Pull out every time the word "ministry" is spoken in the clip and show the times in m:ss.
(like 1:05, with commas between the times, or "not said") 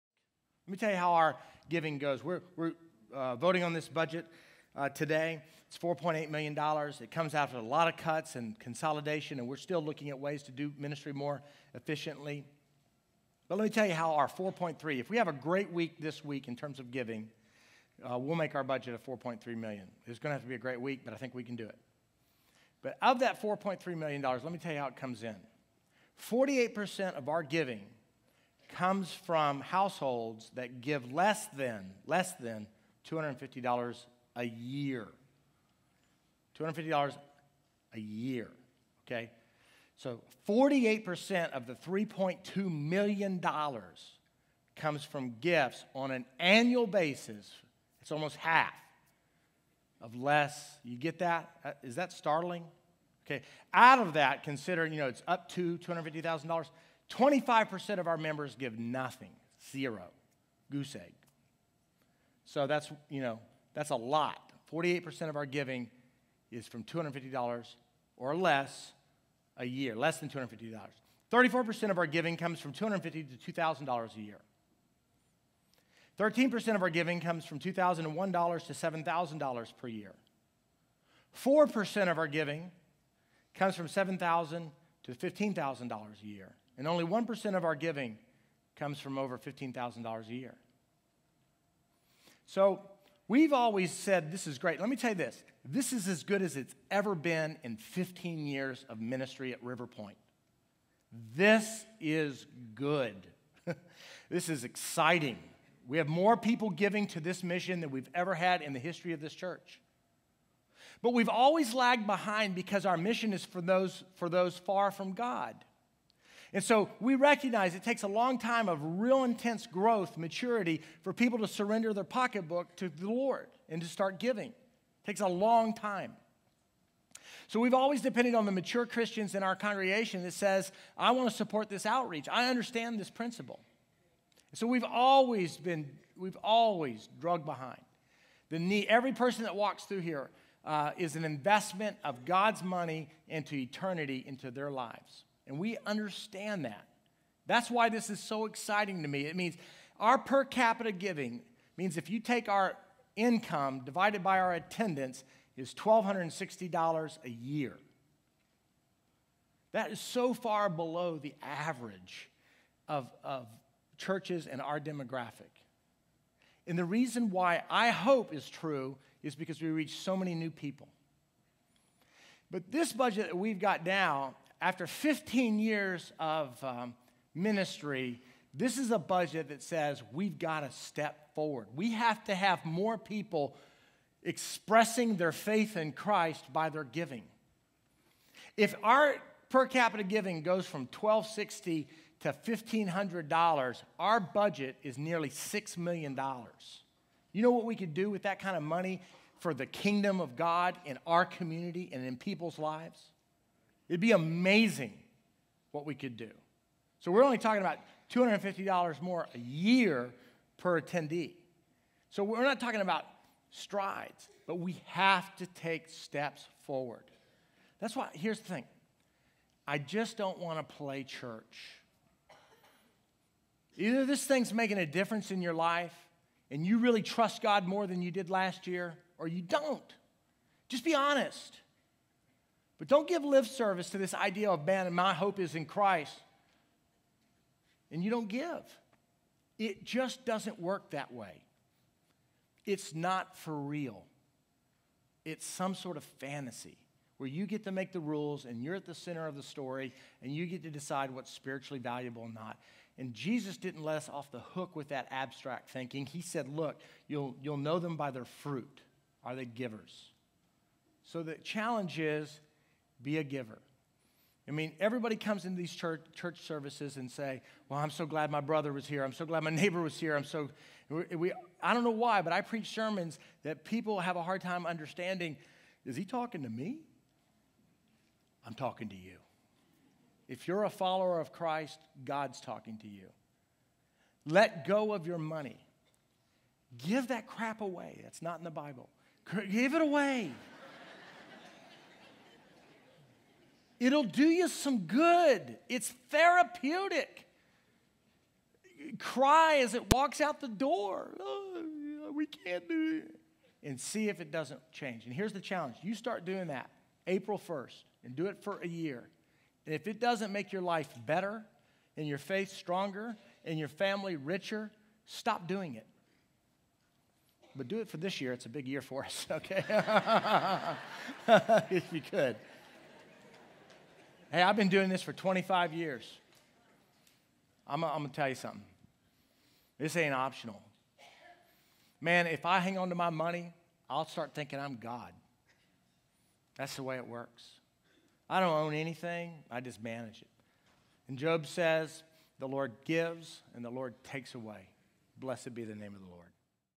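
0:10, 1:38, 2:57.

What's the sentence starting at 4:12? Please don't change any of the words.
And Jesus didn't let us off the hook with that abstract thinking.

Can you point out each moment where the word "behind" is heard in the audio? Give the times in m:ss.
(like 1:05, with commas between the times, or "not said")
1:52, 2:17.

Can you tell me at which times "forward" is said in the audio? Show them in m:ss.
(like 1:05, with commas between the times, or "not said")
3:01, 3:36.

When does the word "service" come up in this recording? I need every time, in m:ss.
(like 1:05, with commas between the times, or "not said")
3:53, 4:26.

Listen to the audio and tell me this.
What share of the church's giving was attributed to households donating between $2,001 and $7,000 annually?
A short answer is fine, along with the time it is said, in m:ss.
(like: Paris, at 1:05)
13%, at 1:16.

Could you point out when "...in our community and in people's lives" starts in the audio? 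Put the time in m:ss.
3:20.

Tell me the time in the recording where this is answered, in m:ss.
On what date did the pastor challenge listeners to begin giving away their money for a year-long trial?
5:07.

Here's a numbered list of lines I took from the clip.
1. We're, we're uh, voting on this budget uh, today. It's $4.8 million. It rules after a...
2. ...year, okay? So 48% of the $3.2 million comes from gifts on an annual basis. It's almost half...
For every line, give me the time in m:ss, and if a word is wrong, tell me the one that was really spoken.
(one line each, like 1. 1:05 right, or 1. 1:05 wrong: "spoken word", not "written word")
1. 0:02 wrong: "comes", not "rules"
2. 0:37 right.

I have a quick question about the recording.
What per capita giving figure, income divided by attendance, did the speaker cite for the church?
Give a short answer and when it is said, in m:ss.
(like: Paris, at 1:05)
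$1,260 a year, at 2:35.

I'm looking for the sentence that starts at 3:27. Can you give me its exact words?
So we're only talking about $250 more a year per attendee.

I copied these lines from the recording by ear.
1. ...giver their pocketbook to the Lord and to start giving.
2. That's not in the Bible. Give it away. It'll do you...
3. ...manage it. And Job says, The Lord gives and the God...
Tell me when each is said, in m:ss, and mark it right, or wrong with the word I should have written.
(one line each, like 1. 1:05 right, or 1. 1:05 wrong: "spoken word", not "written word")
1. 2:01 wrong: "surrender", not "giver"
2. 4:48 right
3. 5:39 wrong: "Lord", not "God".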